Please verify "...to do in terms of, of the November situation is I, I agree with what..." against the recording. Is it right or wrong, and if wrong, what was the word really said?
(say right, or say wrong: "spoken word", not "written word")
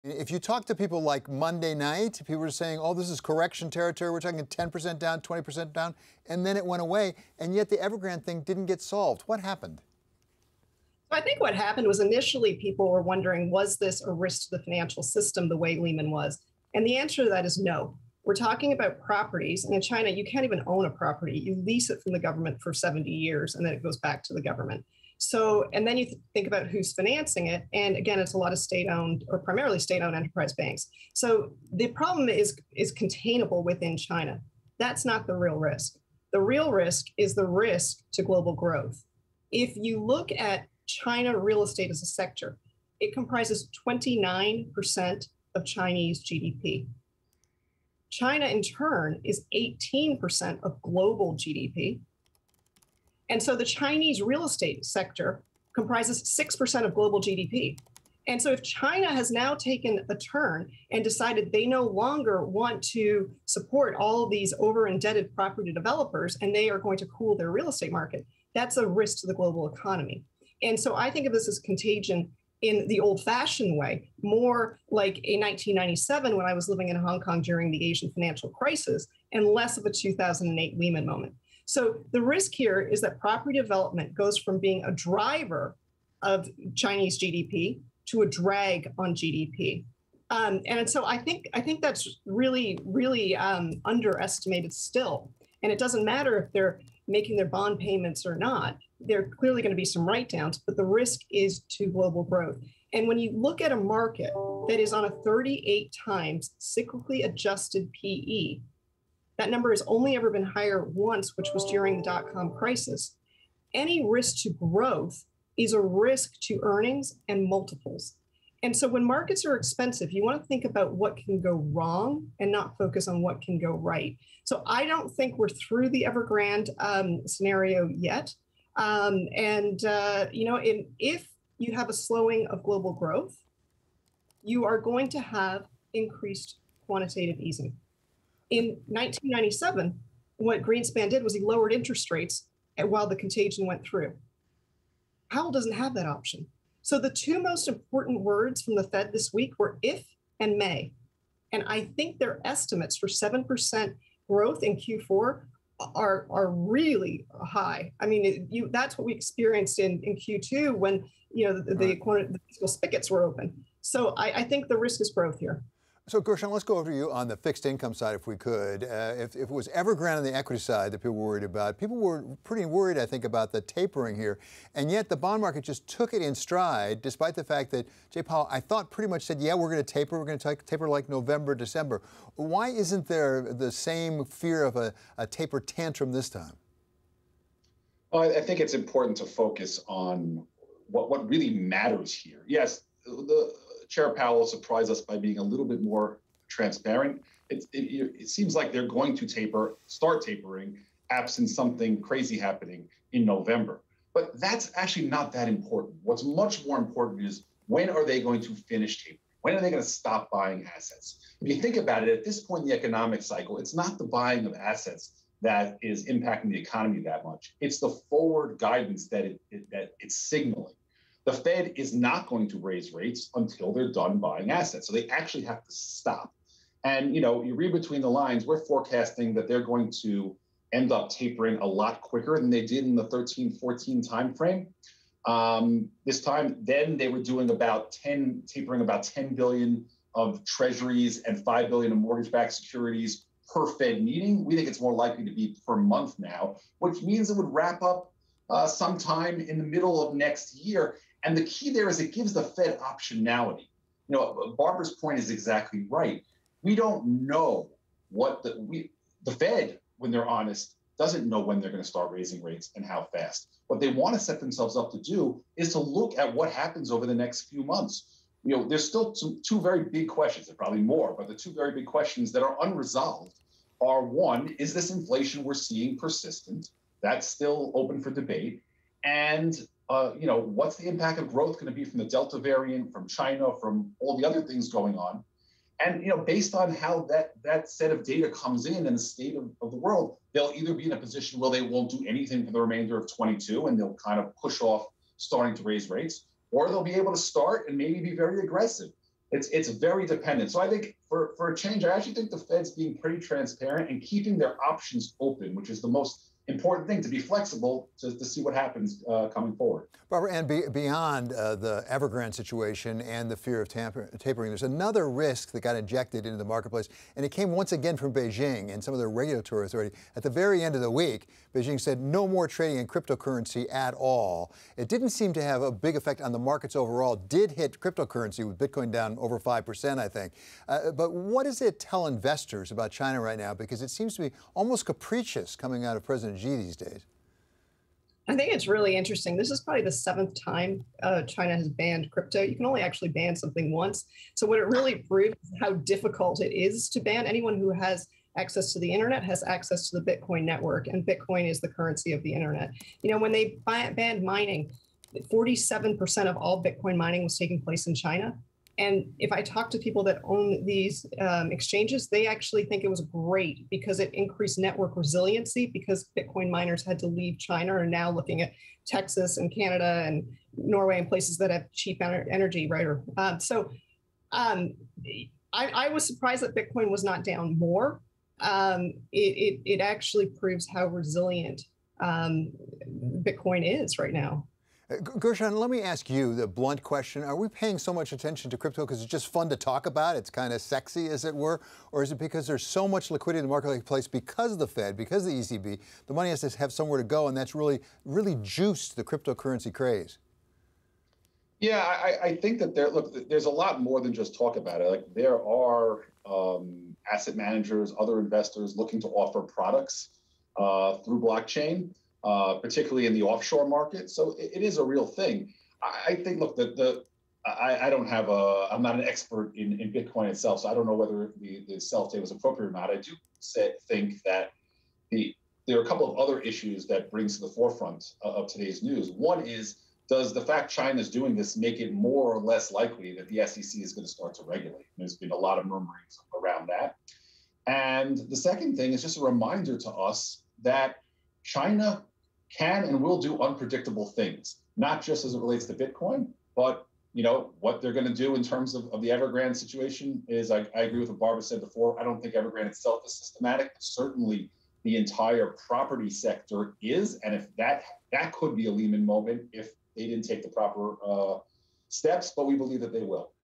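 wrong: "Evergrande", not "November".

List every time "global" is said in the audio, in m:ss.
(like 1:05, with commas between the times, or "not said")
0:38, 0:50, 0:56, 1:09, 1:41, 2:12.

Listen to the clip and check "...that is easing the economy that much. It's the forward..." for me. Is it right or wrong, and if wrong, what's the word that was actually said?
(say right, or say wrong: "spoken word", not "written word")
wrong: "impacting", not "easing".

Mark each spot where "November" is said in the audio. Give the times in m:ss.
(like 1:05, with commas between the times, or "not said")
3:01, 3:23.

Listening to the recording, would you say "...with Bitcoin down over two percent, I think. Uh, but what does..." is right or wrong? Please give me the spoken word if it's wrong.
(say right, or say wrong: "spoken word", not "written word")
wrong: "five", not "two".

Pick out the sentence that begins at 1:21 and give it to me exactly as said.
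So the risk here is that property development goes from being a driver of Chinese GDP to a drag on GDP.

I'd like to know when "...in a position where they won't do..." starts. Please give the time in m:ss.
4:50.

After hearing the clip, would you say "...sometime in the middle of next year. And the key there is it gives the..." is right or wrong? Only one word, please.
right.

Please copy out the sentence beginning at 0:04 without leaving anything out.
We're talking 10% down, 20% down, and then it went away.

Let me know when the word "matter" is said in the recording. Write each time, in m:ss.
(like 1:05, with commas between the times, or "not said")
1:36, 3:11.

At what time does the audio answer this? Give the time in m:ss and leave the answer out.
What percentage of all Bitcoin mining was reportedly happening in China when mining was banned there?
5:55.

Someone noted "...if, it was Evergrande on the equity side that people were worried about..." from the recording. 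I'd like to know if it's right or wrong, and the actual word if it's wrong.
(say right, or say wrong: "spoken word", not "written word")
right.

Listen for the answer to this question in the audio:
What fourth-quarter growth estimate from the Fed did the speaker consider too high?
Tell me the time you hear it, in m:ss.
2:33.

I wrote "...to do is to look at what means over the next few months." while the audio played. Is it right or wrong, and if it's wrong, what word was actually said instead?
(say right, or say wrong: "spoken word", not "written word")
wrong: "happens", not "means".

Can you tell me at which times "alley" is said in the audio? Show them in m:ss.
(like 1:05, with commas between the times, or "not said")
not said.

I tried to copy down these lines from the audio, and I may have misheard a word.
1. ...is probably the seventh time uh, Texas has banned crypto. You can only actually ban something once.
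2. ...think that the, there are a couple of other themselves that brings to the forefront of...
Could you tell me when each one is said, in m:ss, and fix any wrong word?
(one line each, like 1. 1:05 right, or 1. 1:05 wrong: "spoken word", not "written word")
1. 5:39 wrong: "China", not "Texas"
2. 7:03 wrong: "issues", not "themselves".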